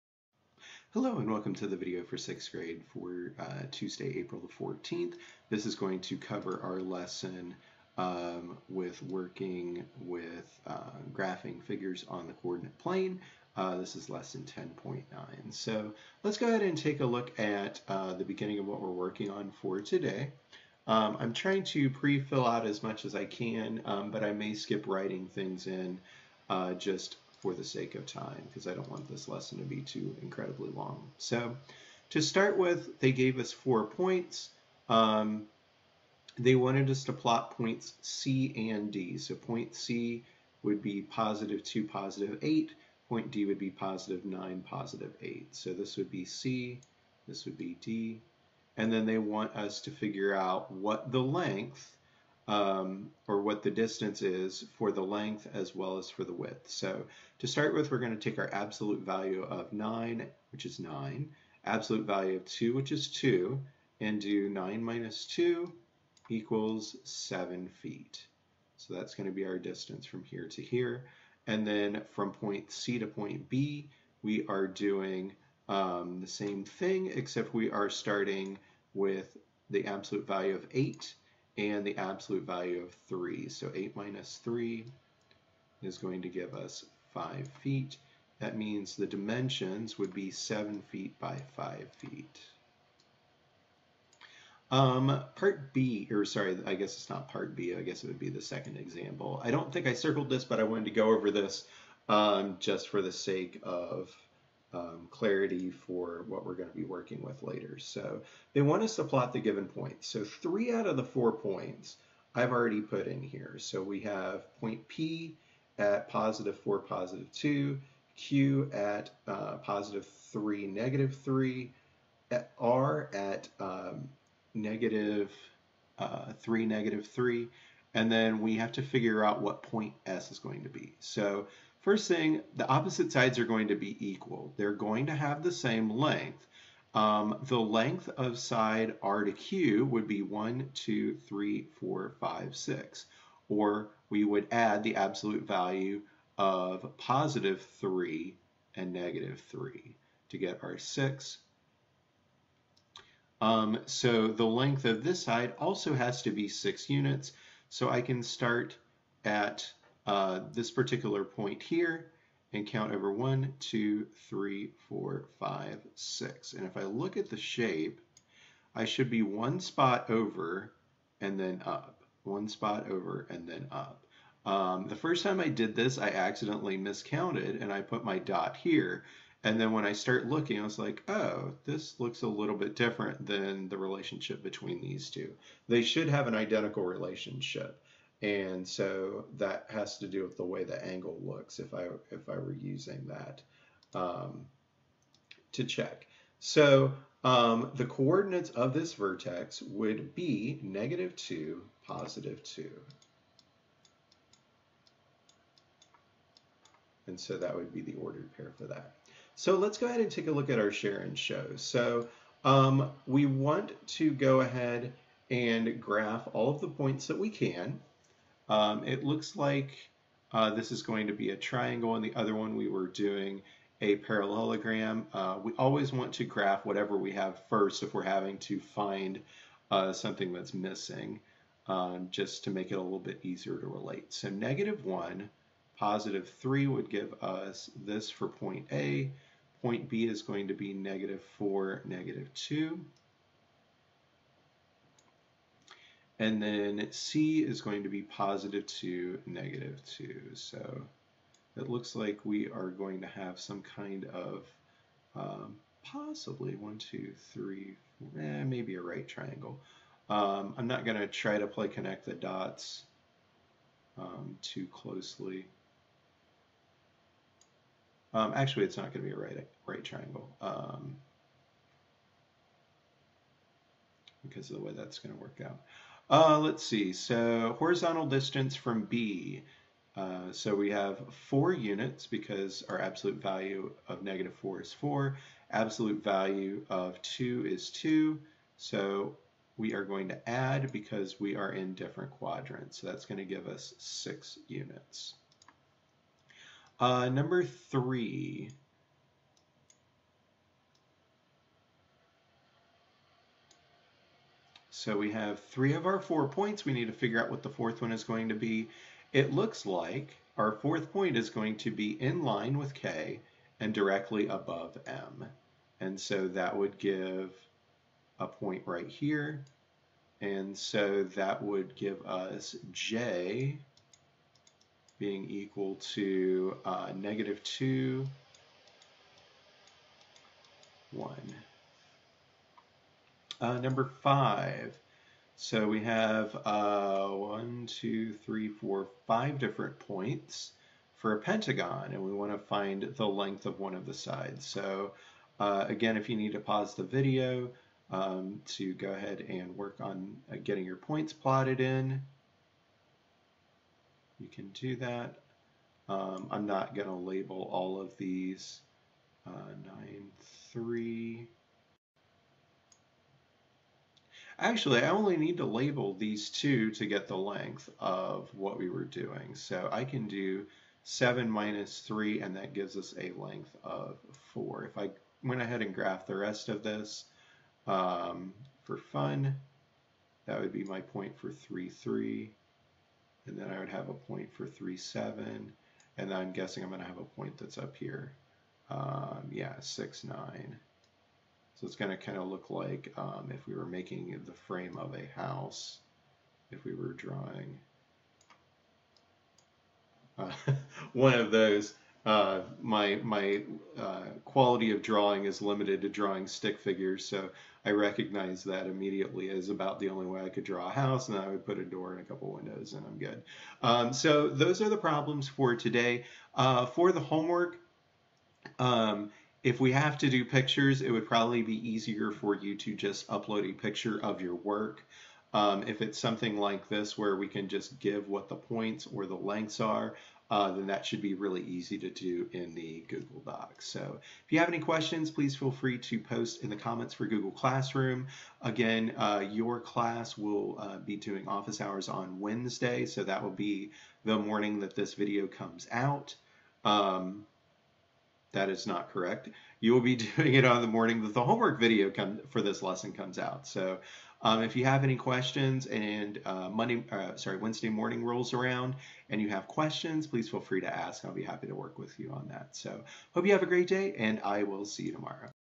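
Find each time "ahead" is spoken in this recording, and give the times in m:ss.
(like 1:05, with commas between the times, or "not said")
0:16, 3:29, 3:34, 5:48, 6:15.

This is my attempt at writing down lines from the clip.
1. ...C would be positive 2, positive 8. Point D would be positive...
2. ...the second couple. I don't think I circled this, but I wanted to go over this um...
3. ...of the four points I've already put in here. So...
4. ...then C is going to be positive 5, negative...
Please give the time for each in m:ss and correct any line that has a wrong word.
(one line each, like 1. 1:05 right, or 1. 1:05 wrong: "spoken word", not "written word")
1. 0:39 right
2. 1:38 wrong: "example", not "couple"
3. 1:50 right
4. 4:06 wrong: "2", not "5".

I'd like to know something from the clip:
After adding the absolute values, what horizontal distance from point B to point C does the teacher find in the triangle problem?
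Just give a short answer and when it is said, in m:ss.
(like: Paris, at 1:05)
6 units, at 4:53.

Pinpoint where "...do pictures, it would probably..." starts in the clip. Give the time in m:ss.
7:00.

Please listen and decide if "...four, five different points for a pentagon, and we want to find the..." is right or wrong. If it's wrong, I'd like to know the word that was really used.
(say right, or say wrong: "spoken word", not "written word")
right.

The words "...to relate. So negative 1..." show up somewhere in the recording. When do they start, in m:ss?
3:53.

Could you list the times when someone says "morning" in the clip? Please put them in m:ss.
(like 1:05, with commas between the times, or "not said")
7:24, 7:30, 7:37.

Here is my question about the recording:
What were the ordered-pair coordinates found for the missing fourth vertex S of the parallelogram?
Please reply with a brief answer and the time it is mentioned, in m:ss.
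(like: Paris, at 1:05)
-2, 2, at 3:20.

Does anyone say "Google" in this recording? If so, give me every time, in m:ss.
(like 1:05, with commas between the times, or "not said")
7:12, 7:17.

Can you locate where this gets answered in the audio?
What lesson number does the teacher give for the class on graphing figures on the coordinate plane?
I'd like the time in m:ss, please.
0:14.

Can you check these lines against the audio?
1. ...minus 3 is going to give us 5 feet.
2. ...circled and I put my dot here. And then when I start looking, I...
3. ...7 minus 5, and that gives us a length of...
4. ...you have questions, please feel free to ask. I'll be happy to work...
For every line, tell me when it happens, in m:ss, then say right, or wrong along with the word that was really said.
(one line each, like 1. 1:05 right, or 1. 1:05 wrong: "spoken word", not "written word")
1. 1:23 right
2. 2:56 wrong: "miscounted", not "circled"
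3. 6:10 wrong: "3", not "5"
4. 7:39 right.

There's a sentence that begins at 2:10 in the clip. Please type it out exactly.
So First thing, the opposite sides are going to be equal.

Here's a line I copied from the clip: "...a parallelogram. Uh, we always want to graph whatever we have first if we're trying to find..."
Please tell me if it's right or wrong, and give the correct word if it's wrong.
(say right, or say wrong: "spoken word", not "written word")
wrong: "having", not "trying".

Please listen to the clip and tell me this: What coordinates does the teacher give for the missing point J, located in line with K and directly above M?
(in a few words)
-2, 1.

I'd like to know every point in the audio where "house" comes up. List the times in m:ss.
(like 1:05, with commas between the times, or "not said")
6:35, 6:50.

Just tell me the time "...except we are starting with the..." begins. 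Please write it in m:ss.
1:17.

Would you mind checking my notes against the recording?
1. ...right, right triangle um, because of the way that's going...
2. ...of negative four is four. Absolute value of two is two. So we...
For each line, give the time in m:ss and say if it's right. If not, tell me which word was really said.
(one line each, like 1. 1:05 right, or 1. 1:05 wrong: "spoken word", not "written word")
1. 4:29 right
2. 4:43 right.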